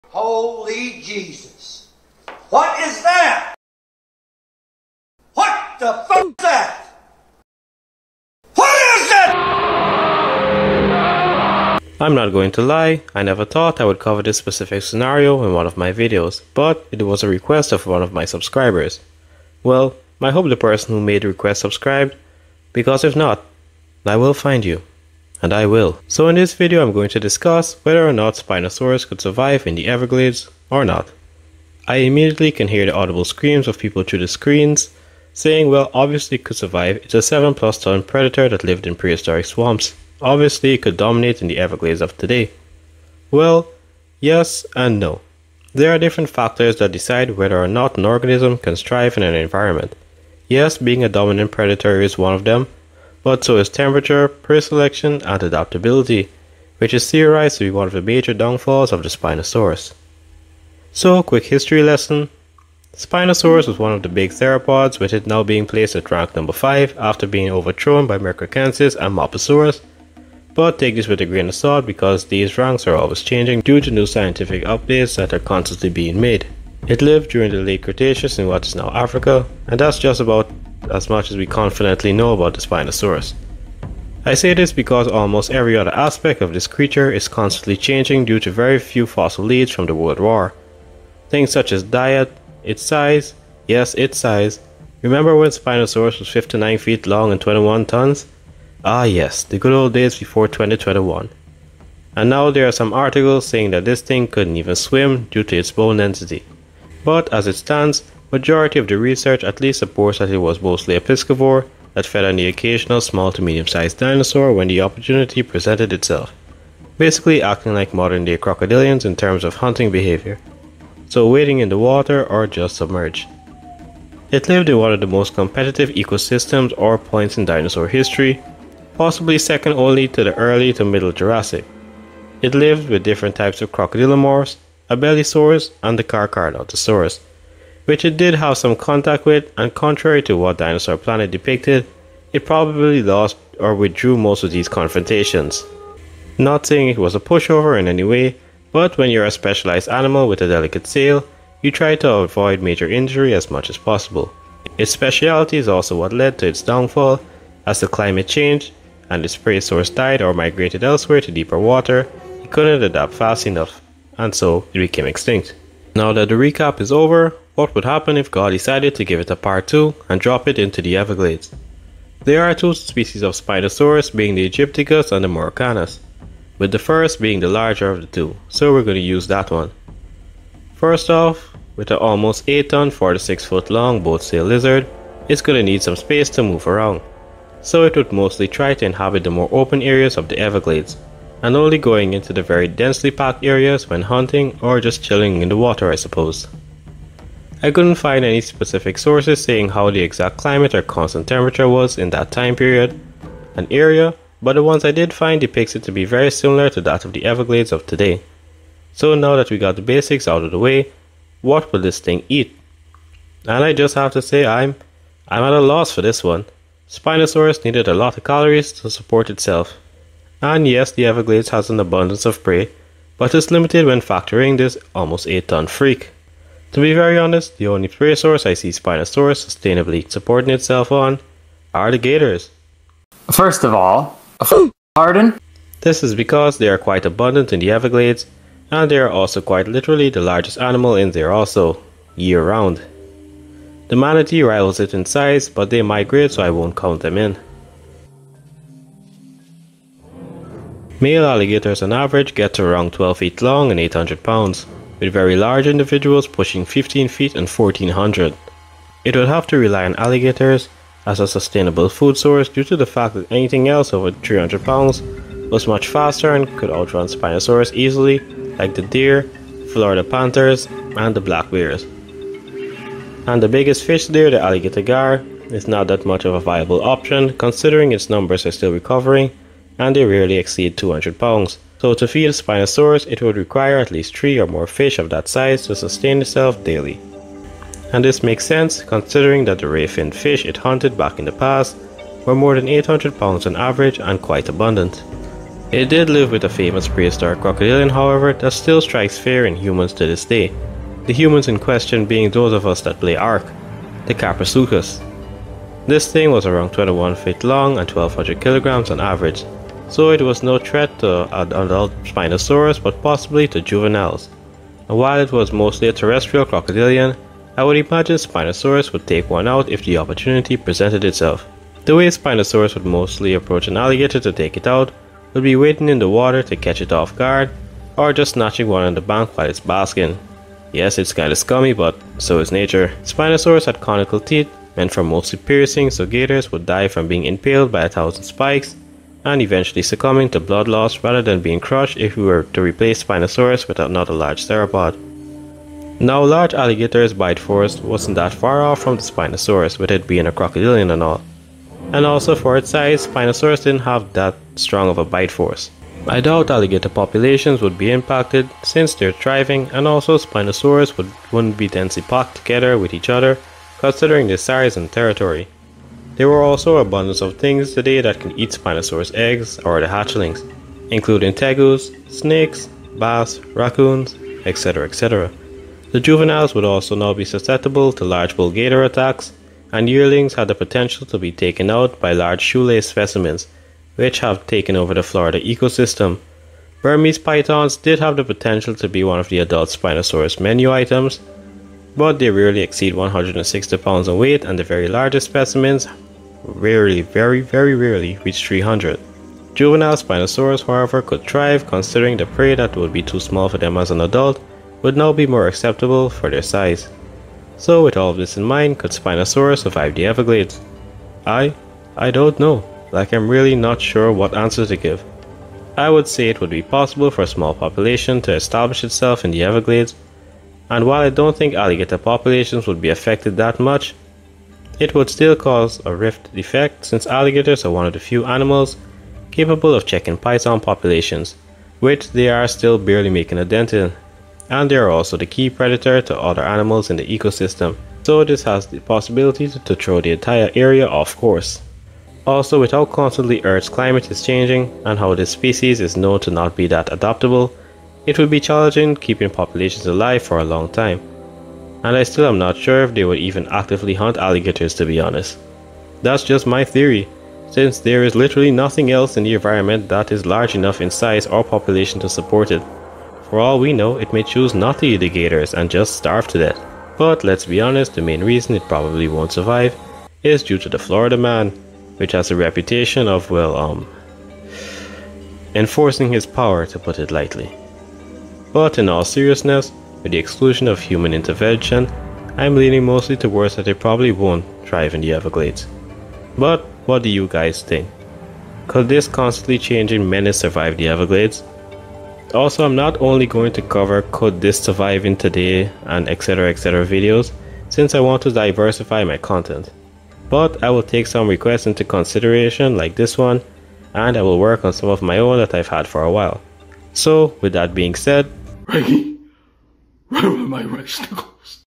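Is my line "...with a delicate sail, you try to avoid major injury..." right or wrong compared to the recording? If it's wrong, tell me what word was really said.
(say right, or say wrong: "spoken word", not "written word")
right.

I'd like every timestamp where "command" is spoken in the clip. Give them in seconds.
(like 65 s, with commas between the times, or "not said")
not said.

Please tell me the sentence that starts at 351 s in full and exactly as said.
And also for its size, Spinosaurus didn't have that strong of a bite force.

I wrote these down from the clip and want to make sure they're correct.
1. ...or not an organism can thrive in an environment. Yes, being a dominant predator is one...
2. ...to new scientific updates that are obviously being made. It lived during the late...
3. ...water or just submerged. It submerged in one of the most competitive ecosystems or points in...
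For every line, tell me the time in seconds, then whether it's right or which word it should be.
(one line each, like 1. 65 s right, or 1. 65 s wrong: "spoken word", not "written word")
1. 47 s right
2. 73 s wrong: "constantly", not "obviously"
3. 121 s wrong: "lived", not "submerged".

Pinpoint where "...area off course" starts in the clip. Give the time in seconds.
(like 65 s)
440 s.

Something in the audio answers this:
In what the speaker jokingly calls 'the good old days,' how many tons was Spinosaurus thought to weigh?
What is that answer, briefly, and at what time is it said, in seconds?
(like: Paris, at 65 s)
21 tons, at 97 s.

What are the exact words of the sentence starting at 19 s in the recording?
Well, I hope the person who made the request subscribed, because if not, I will find you and I will.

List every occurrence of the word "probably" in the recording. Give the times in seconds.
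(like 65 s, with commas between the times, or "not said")
142 s, 468 s, 483 s.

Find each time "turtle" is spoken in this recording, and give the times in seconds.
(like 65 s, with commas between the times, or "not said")
not said.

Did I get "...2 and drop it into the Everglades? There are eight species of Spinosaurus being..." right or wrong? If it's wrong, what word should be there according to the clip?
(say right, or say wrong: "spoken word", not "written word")
wrong: "two", not "eight".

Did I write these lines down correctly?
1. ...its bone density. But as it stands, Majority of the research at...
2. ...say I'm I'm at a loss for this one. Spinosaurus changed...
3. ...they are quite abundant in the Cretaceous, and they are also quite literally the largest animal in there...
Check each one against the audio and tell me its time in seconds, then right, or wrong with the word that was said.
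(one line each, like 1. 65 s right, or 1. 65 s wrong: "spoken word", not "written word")
1. 105 s right
2. 214 s wrong: "needed", not "changed"
3. 236 s wrong: "Everglades", not "Cretaceous".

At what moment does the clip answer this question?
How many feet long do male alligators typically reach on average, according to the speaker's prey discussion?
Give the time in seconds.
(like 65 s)
252 s.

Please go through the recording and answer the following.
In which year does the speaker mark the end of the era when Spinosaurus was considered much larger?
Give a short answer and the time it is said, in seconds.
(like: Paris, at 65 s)
2021, at 100 s.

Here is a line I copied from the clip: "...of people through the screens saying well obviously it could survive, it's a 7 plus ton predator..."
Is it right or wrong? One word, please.
right.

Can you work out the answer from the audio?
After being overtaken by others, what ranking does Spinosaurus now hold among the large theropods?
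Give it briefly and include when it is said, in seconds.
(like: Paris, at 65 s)
5, at 66 s.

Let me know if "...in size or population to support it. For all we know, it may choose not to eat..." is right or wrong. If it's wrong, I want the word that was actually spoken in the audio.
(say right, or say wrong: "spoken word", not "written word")
right.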